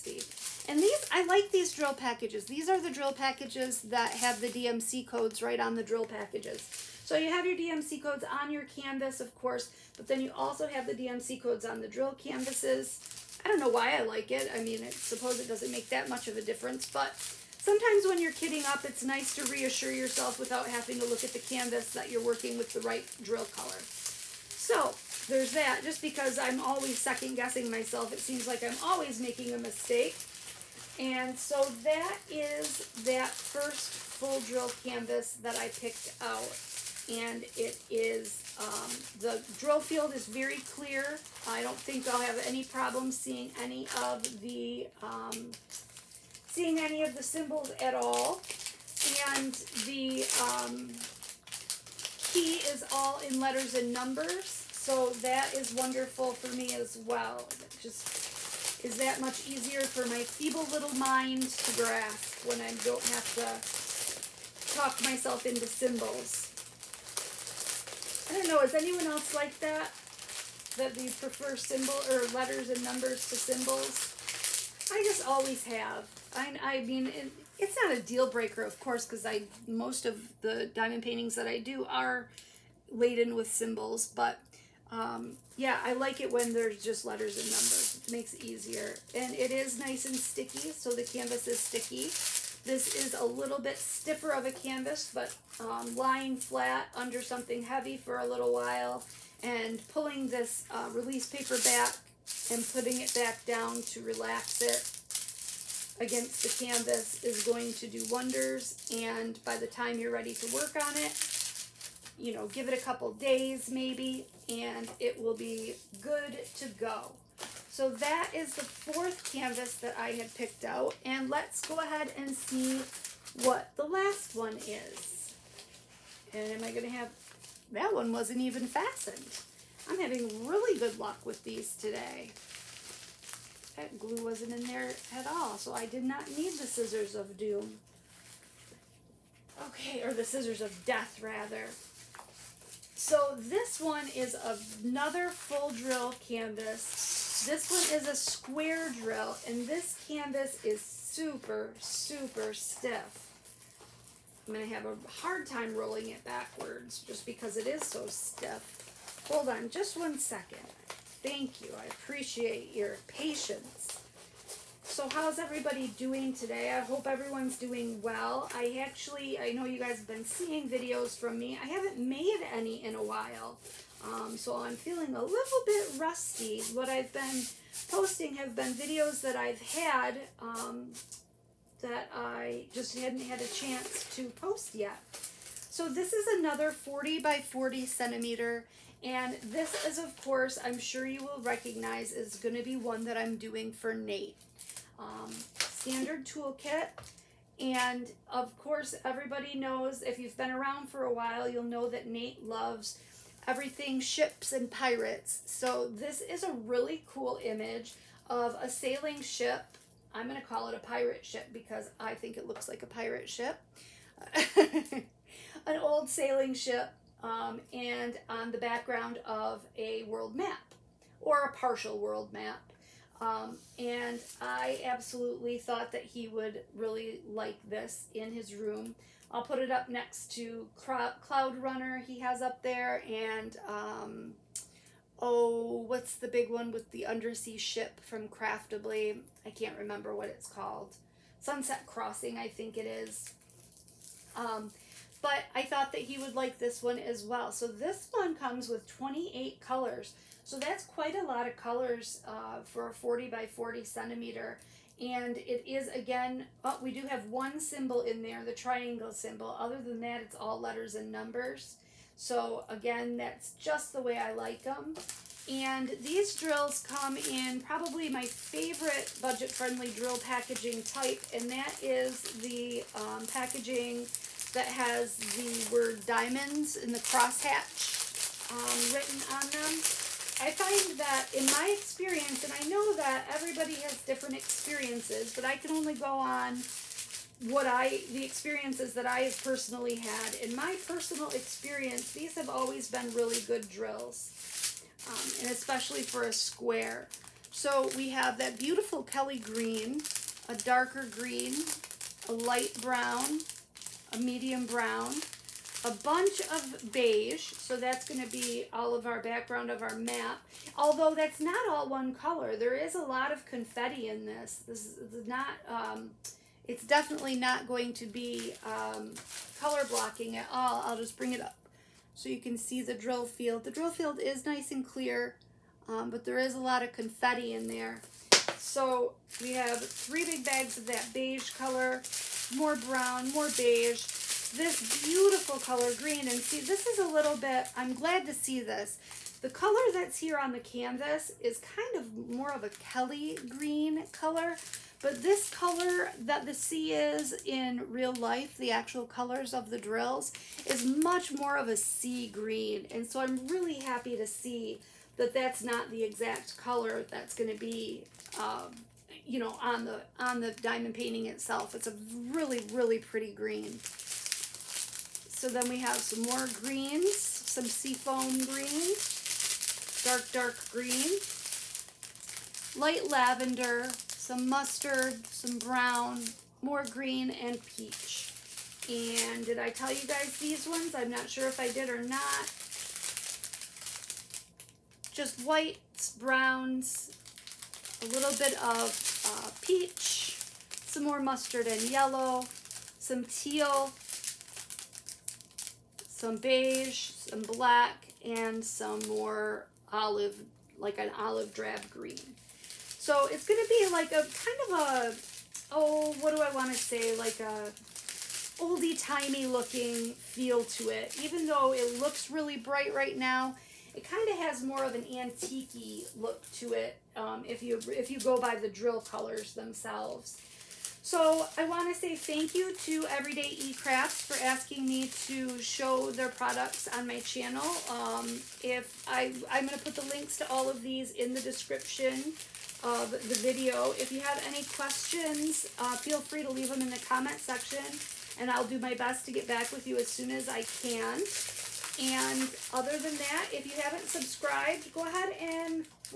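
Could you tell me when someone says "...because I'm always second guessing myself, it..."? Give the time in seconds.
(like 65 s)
26 s.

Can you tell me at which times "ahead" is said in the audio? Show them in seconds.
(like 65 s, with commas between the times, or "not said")
121 s, 445 s.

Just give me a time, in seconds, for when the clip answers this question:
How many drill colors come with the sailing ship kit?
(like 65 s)
248 s.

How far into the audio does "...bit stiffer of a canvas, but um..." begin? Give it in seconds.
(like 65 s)
93 s.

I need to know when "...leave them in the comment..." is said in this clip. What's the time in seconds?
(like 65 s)
436 s.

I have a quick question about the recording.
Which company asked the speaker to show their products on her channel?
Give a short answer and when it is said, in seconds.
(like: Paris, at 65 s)
Everyday E-Crafts, at 423 s.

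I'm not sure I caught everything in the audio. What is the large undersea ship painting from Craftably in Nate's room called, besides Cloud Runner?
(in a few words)
Sunset Crossing.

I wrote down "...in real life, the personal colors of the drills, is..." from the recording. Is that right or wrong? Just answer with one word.
wrong.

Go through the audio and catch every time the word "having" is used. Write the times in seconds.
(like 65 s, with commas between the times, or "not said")
20 s, 129 s.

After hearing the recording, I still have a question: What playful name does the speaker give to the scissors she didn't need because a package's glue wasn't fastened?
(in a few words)
scissors of death.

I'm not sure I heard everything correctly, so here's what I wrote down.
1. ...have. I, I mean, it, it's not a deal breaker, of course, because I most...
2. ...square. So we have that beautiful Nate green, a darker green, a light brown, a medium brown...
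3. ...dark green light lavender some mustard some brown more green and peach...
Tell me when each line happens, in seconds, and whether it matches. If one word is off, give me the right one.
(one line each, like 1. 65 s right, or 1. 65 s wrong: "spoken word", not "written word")
1. 75 s right
2. 296 s wrong: "Kelly", not "Nate"
3. 370 s right.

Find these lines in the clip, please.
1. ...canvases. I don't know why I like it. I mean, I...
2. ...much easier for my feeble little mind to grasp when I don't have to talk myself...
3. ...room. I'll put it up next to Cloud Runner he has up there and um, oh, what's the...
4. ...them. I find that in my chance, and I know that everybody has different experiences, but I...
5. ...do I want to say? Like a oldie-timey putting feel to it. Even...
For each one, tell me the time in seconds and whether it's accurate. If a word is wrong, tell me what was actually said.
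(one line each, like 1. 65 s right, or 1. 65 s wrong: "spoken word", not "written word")
1. 12 s right
2. 59 s right
3. 228 s right
4. 279 s wrong: "experience", not "chance"
5. 406 s wrong: "looking", not "putting".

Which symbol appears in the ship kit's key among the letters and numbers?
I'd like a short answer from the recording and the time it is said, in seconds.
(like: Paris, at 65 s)
triangle, at 258 s.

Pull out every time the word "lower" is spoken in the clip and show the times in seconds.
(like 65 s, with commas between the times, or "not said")
not said.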